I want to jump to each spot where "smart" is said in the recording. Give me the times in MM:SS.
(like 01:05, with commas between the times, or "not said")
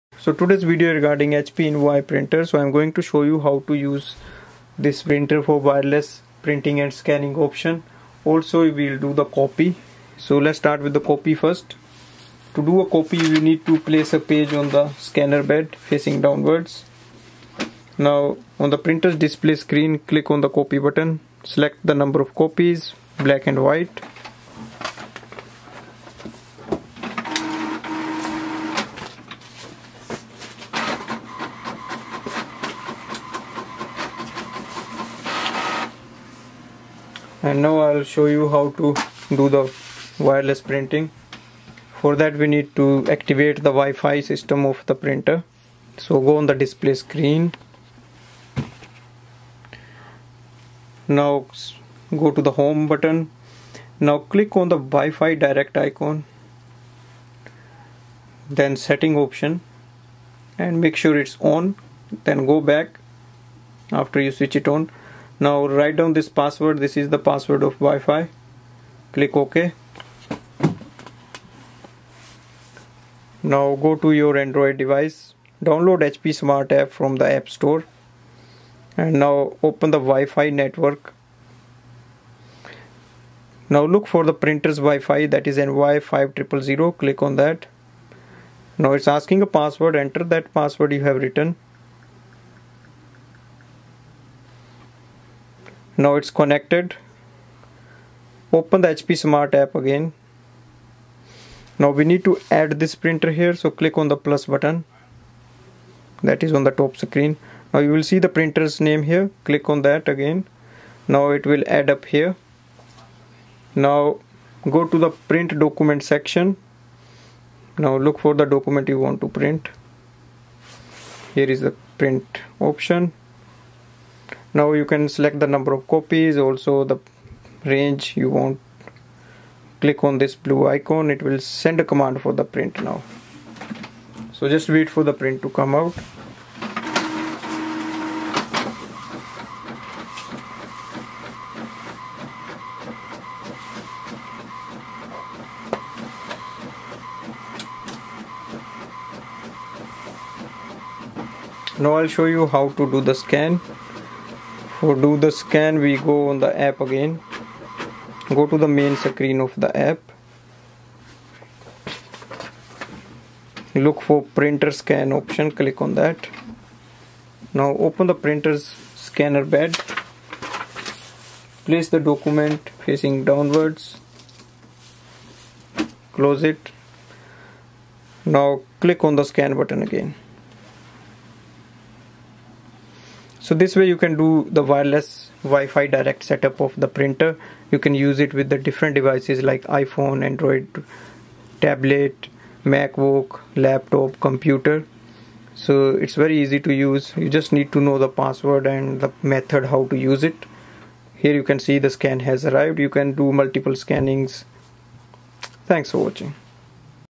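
01:16, 01:39.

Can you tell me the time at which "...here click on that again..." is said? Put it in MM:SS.
01:49.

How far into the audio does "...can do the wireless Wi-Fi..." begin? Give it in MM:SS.
03:03.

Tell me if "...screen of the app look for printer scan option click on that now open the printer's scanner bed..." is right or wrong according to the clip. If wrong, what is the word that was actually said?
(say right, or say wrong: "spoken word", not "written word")
right.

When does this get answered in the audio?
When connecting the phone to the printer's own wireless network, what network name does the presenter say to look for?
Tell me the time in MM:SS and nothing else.
01:25.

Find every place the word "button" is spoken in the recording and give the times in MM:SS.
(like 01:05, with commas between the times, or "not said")
00:20, 00:52, 01:44, 02:59.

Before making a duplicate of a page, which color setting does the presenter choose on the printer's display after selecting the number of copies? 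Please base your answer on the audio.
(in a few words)
black and white.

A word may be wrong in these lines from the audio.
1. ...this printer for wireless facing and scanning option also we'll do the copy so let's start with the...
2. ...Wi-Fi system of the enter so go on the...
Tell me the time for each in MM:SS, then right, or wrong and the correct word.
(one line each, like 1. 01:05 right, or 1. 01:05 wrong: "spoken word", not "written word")
1. 00:04 wrong: "printing", not "facing"
2. 00:43 wrong: "printer", not "enter".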